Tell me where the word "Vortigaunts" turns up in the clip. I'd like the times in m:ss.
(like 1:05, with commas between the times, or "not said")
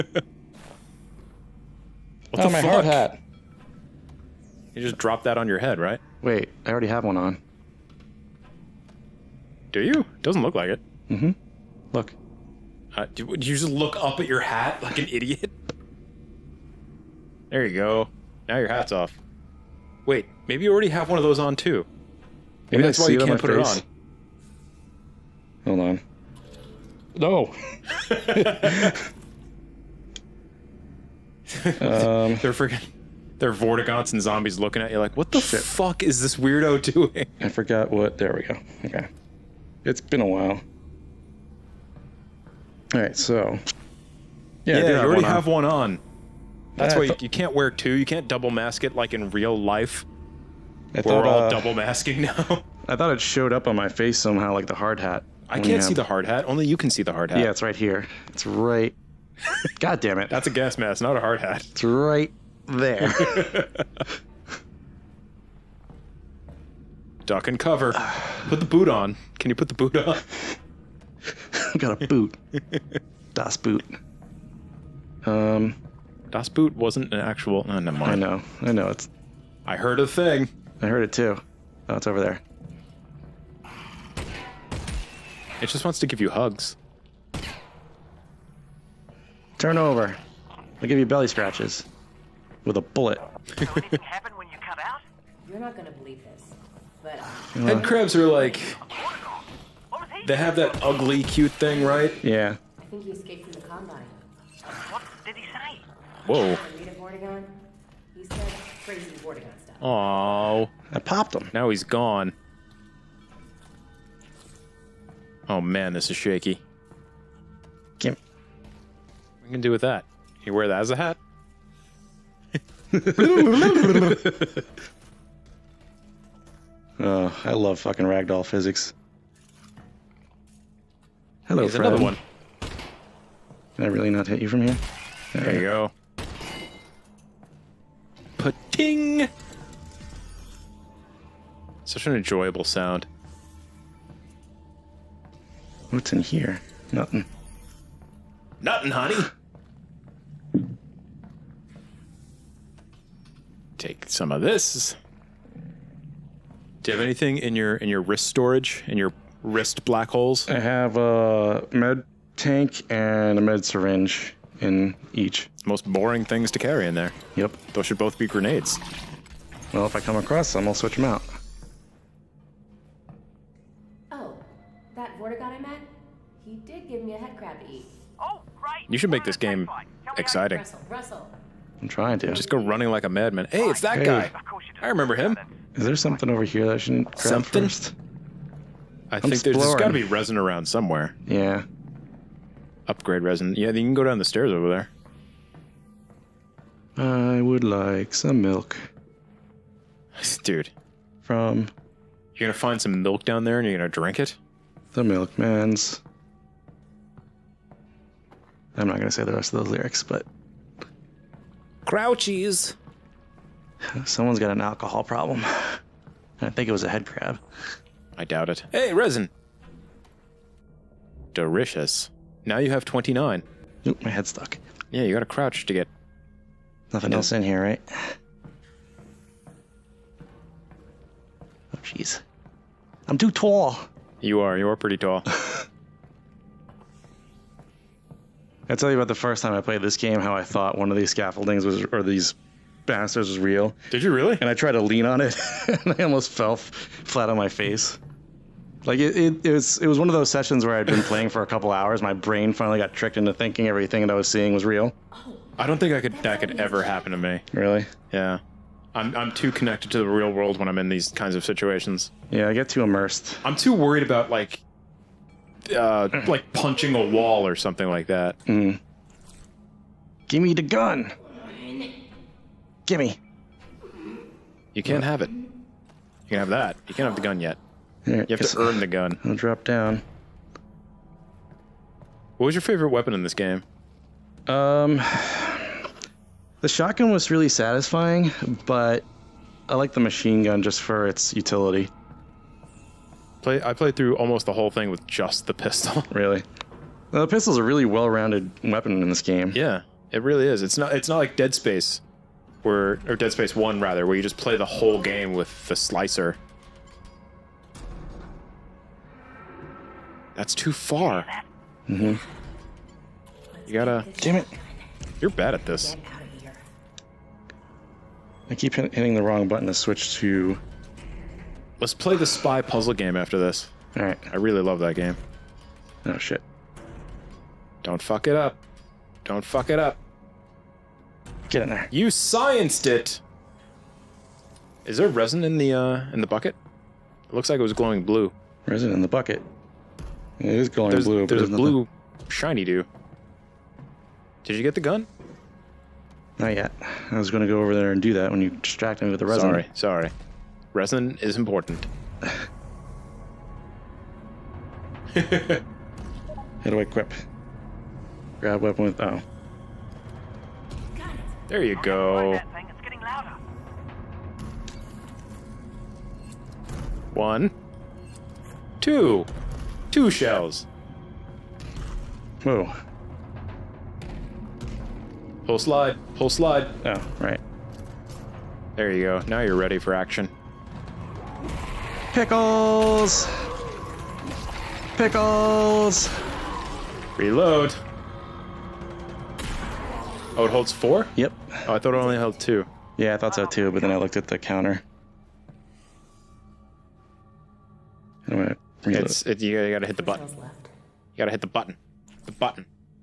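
0:33, 1:49.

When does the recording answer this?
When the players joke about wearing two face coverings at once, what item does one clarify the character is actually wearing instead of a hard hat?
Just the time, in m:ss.
1:00.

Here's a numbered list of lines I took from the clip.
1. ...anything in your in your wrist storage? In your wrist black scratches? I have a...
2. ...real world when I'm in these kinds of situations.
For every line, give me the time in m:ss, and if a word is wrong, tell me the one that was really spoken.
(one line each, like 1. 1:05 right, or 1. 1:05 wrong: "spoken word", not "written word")
1. 2:37 wrong: "holes", not "scratches"
2. 4:20 right.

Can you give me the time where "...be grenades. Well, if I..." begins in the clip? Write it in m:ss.
2:48.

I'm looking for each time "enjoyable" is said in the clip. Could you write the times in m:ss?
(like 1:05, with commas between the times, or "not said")
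2:22.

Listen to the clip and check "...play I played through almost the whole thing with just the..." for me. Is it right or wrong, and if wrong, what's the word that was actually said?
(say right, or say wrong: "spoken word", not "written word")
right.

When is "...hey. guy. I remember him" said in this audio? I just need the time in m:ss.
3:03.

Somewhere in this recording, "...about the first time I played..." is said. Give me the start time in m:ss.
3:58.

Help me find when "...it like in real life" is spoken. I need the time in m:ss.
0:48.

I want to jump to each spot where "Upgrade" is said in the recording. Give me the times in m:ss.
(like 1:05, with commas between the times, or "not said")
3:12.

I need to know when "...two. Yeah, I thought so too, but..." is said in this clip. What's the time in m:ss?
6:32.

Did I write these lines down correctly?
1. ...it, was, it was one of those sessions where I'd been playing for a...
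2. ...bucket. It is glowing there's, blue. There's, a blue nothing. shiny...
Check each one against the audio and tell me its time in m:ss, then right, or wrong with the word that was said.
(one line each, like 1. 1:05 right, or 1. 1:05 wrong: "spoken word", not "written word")
1. 4:09 right
2. 5:39 right.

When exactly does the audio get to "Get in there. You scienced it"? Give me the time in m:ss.
5:31.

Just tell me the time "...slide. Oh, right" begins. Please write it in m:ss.
6:16.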